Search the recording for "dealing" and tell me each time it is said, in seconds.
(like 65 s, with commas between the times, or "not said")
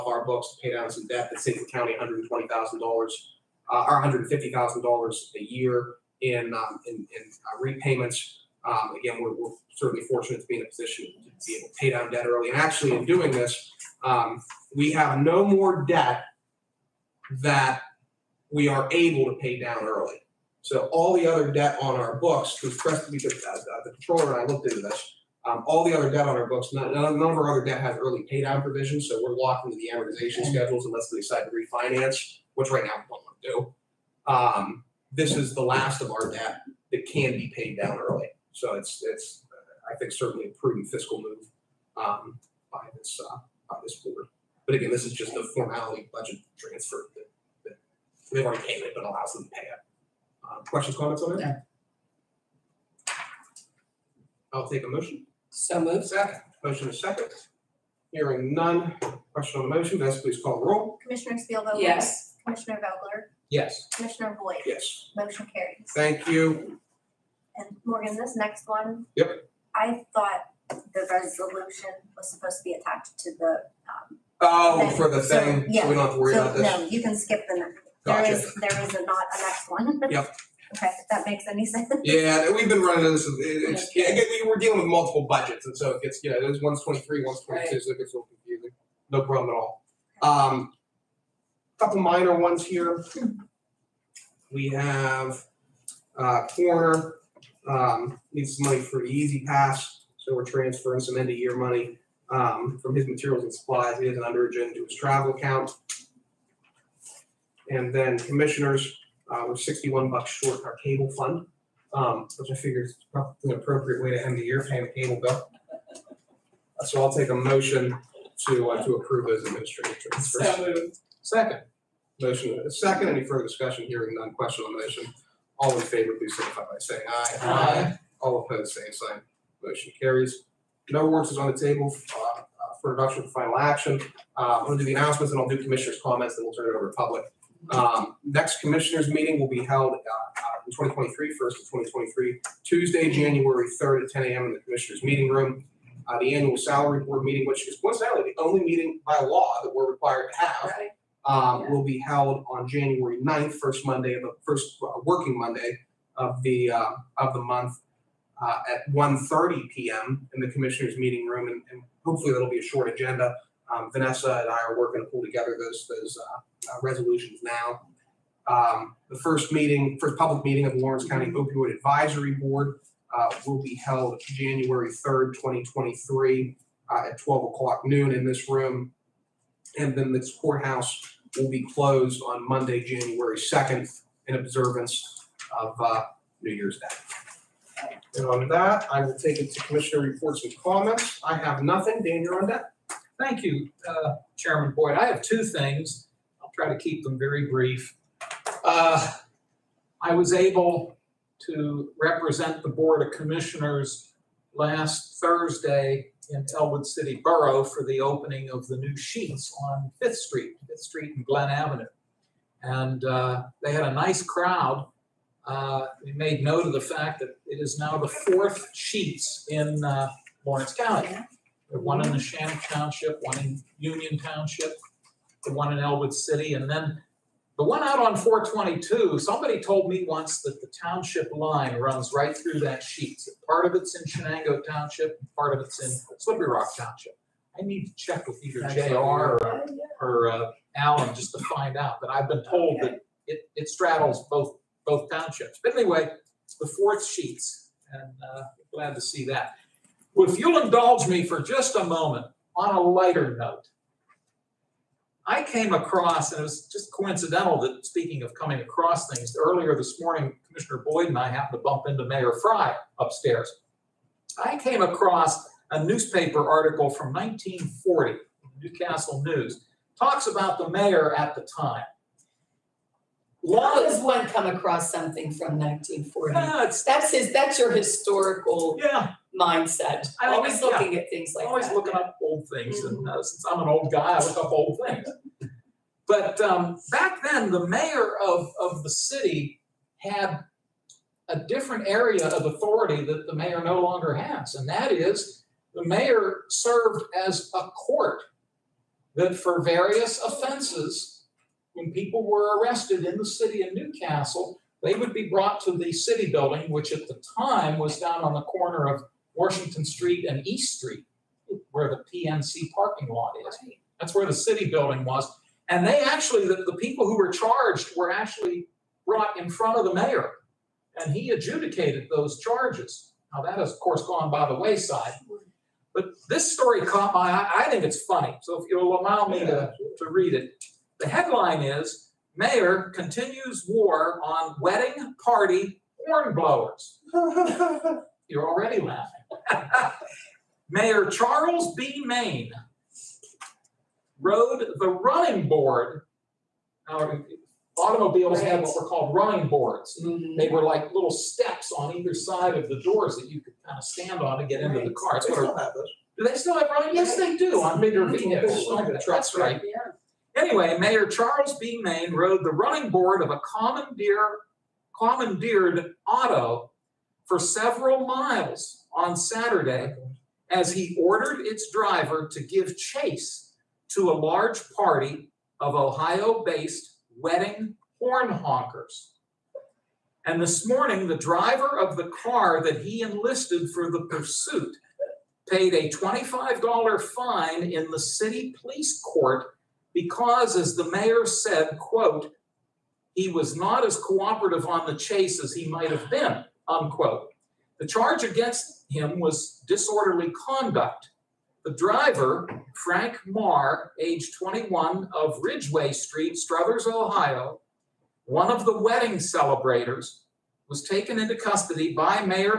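84 s.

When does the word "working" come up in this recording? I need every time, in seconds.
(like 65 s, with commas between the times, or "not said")
155 s, 164 s.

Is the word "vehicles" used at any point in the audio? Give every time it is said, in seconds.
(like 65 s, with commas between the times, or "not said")
358 s.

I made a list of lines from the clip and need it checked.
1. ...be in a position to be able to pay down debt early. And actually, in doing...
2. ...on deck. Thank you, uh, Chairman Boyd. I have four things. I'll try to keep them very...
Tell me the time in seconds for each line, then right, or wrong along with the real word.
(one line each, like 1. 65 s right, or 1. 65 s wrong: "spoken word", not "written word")
1. 10 s right
2. 192 s wrong: "two", not "four".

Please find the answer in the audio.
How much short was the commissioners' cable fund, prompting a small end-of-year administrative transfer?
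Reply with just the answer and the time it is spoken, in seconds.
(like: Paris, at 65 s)
$61, at 109 s.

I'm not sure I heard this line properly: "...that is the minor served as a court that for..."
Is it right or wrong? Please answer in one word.
wrong.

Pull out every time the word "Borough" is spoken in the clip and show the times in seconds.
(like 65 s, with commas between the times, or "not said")
207 s.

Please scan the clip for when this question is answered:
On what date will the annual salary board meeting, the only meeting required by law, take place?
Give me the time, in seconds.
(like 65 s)
152 s.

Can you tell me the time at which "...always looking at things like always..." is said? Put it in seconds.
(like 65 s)
280 s.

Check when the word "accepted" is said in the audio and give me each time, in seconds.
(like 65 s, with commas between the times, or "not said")
not said.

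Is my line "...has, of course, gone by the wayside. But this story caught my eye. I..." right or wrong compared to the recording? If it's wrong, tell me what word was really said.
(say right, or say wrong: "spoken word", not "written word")
right.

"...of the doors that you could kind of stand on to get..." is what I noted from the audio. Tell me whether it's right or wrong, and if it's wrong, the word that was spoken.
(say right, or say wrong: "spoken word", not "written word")
right.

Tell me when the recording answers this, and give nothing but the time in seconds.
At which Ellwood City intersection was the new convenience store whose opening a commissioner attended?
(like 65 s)
210 s.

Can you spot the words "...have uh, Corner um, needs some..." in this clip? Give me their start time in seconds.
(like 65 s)
94 s.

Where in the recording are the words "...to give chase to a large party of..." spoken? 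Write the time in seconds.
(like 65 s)
372 s.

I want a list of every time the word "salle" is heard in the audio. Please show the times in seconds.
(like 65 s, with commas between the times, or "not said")
not said.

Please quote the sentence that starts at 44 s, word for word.
But again, this is just a formality budget transfer that, that they've already paid it, but allows them to pay it.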